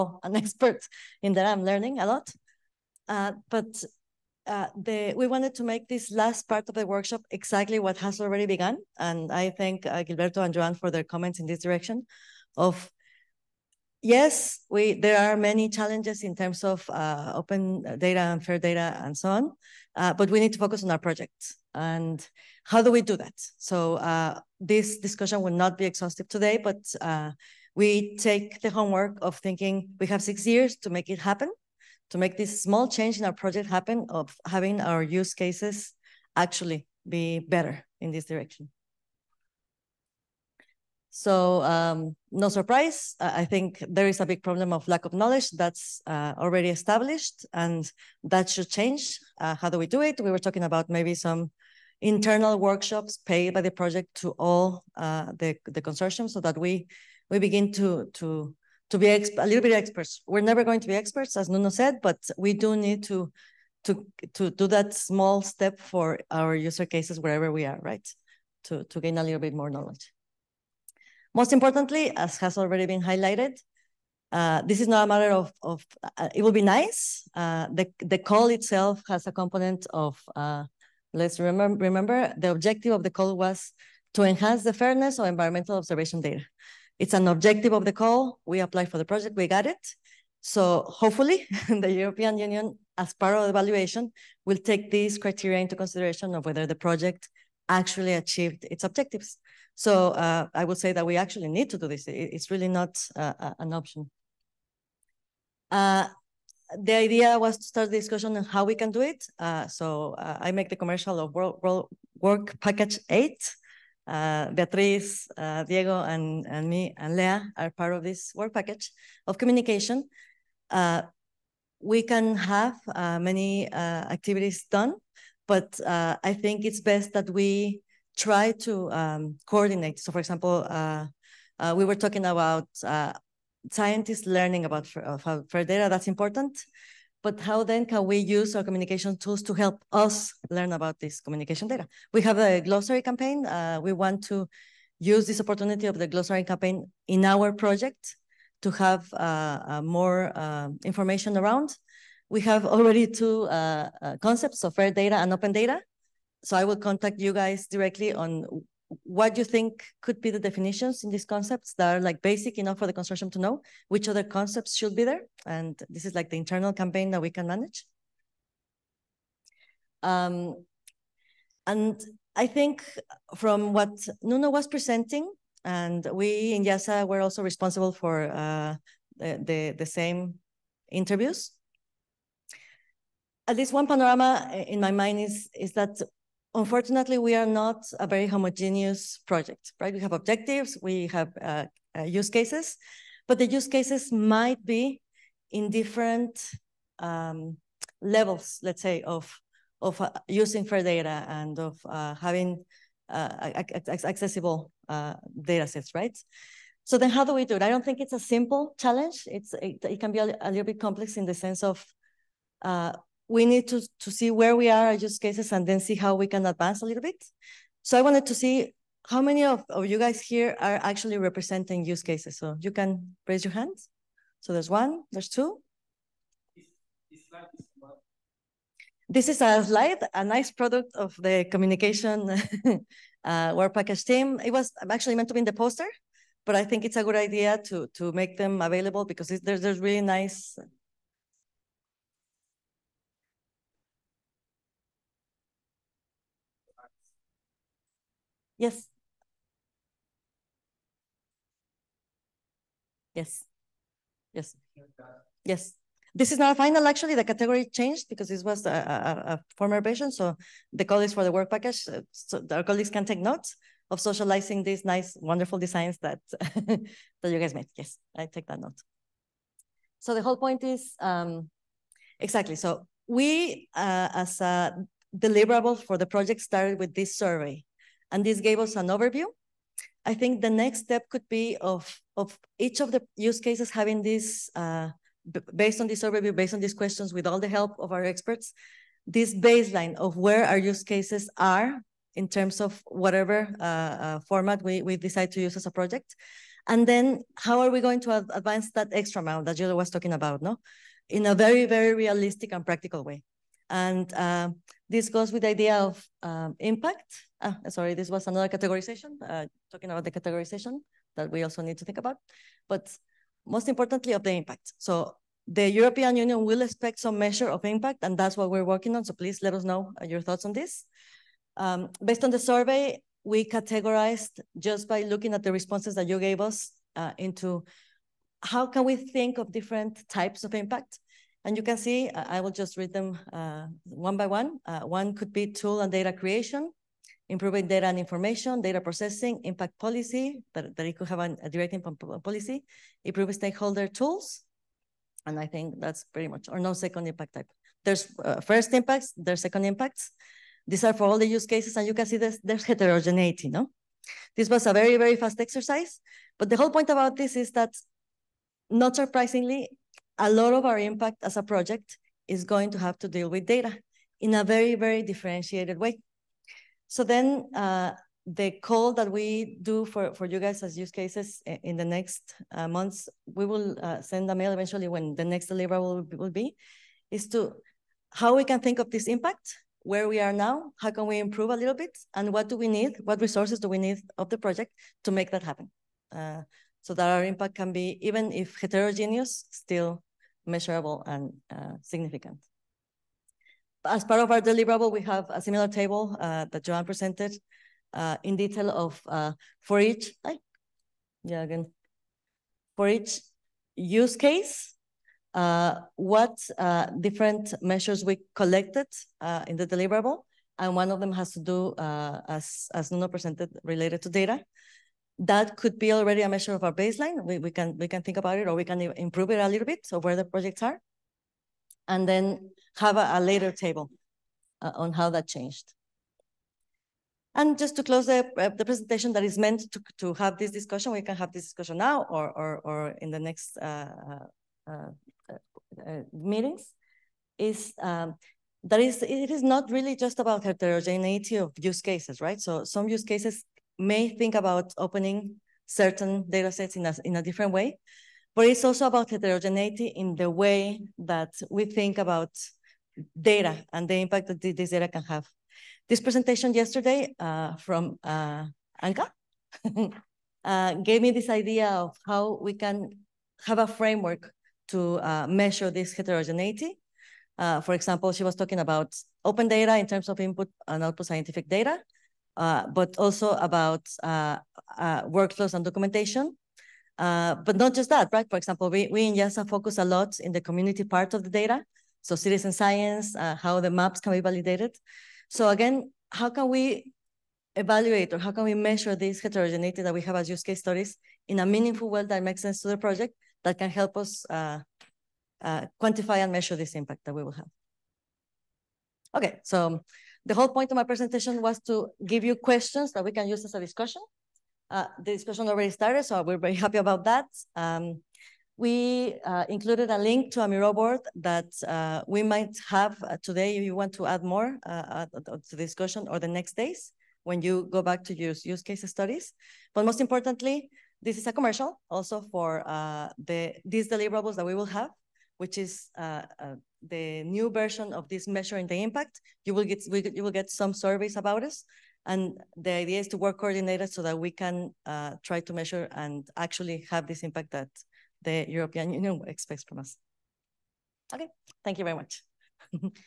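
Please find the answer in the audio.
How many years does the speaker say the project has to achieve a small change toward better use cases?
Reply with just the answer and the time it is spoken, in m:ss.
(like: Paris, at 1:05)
6, at 0:30.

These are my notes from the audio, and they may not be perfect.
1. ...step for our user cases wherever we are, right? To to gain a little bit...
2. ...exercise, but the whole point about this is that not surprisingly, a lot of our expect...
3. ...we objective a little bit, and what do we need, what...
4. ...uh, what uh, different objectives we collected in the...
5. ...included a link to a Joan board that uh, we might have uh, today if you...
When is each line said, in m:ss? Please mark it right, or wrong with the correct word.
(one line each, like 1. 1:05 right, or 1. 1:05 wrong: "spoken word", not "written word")
1. 1:05 right
2. 5:55 wrong: "impact", not "expect"
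3. 6:21 wrong: "improve", not "objective"
4. 6:45 wrong: "measures", not "objectives"
5. 8:29 wrong: "Miro", not "Joan".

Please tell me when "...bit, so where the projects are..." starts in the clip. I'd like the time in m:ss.
6:59.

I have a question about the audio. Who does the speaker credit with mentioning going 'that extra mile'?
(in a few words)
Jill.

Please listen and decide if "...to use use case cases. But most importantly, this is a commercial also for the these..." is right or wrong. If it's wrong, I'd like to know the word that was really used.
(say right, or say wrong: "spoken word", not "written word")
wrong: "studies", not "cases".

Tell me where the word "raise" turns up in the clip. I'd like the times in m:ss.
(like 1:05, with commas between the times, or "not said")
3:43.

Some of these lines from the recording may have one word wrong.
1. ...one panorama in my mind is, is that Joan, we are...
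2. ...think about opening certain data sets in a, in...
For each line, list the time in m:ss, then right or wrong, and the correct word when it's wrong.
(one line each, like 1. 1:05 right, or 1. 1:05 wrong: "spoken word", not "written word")
1. 3:03 wrong: "Unfortunately", not "Joan"
2. 7:24 right.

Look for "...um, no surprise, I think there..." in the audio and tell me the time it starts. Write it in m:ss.
0:41.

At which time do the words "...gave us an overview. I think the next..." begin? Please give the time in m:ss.
4:38.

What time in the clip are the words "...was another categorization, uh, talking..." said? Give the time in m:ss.
5:08.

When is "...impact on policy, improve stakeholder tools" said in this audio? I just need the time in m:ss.
5:41.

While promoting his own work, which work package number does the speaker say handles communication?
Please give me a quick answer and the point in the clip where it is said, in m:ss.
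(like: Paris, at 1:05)
8, at 1:53.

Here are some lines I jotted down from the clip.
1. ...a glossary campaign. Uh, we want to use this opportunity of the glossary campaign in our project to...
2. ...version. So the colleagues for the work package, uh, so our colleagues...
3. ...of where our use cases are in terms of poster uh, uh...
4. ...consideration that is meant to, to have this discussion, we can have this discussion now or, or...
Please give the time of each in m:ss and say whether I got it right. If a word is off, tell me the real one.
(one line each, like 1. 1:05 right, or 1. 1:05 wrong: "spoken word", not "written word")
1. 2:22 right
2. 4:19 right
3. 4:49 wrong: "whatever", not "poster"
4. 7:08 wrong: "presentation", not "consideration".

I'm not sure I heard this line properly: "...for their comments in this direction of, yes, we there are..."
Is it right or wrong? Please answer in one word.
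right.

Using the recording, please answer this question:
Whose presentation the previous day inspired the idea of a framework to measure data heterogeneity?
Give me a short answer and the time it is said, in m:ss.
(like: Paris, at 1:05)
Anka, at 7:38.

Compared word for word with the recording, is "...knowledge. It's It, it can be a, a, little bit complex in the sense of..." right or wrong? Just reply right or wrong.
wrong.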